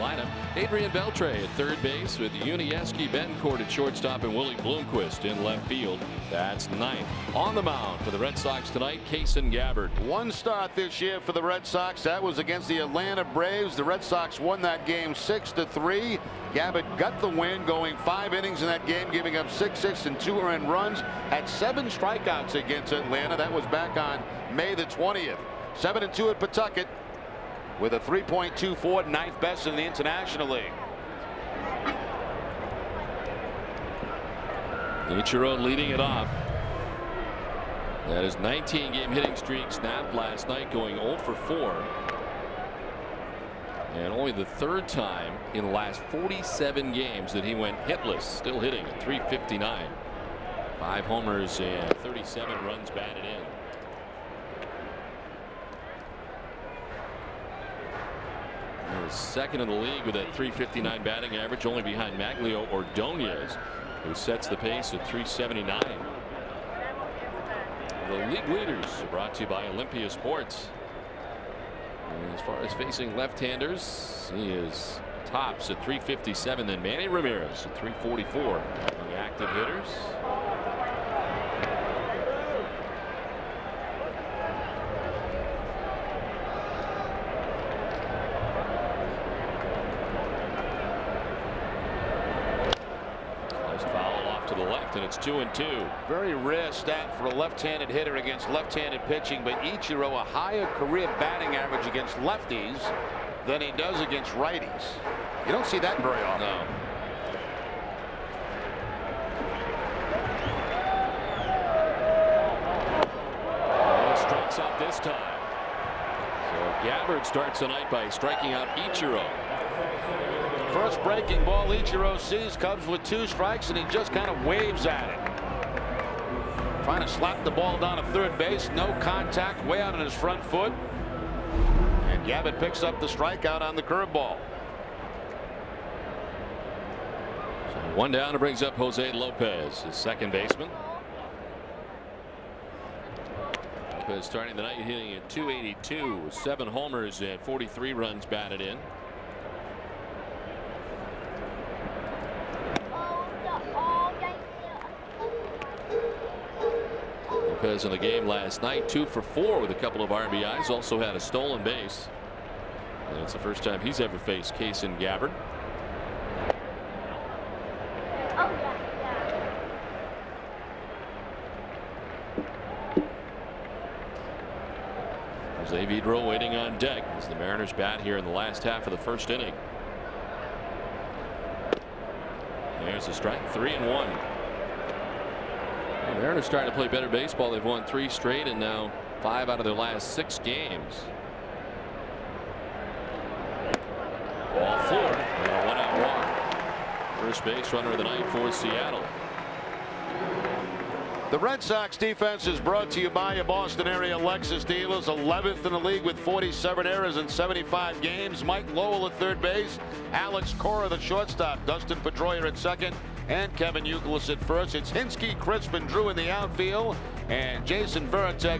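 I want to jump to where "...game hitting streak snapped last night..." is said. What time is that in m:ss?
0:38.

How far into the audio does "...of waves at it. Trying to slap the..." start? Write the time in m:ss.
2:04.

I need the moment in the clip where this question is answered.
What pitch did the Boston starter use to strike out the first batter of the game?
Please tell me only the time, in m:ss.
2:13.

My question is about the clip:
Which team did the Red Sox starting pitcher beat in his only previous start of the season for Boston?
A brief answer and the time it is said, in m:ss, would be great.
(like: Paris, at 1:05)
Atlanta Braves, at 0:12.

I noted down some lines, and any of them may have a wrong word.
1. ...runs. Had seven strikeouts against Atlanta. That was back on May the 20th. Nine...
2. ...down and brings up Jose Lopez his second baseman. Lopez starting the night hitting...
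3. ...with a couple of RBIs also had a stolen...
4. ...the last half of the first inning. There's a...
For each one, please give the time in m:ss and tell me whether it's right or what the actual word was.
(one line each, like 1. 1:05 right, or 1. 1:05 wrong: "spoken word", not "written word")
1. 0:20 wrong: "Seven", not "Nine"
2. 2:18 right
3. 2:39 right
4. 2:58 right.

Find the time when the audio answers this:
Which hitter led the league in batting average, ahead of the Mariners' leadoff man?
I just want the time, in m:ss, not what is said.
1:02.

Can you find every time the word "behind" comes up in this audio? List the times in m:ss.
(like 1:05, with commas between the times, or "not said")
1:01.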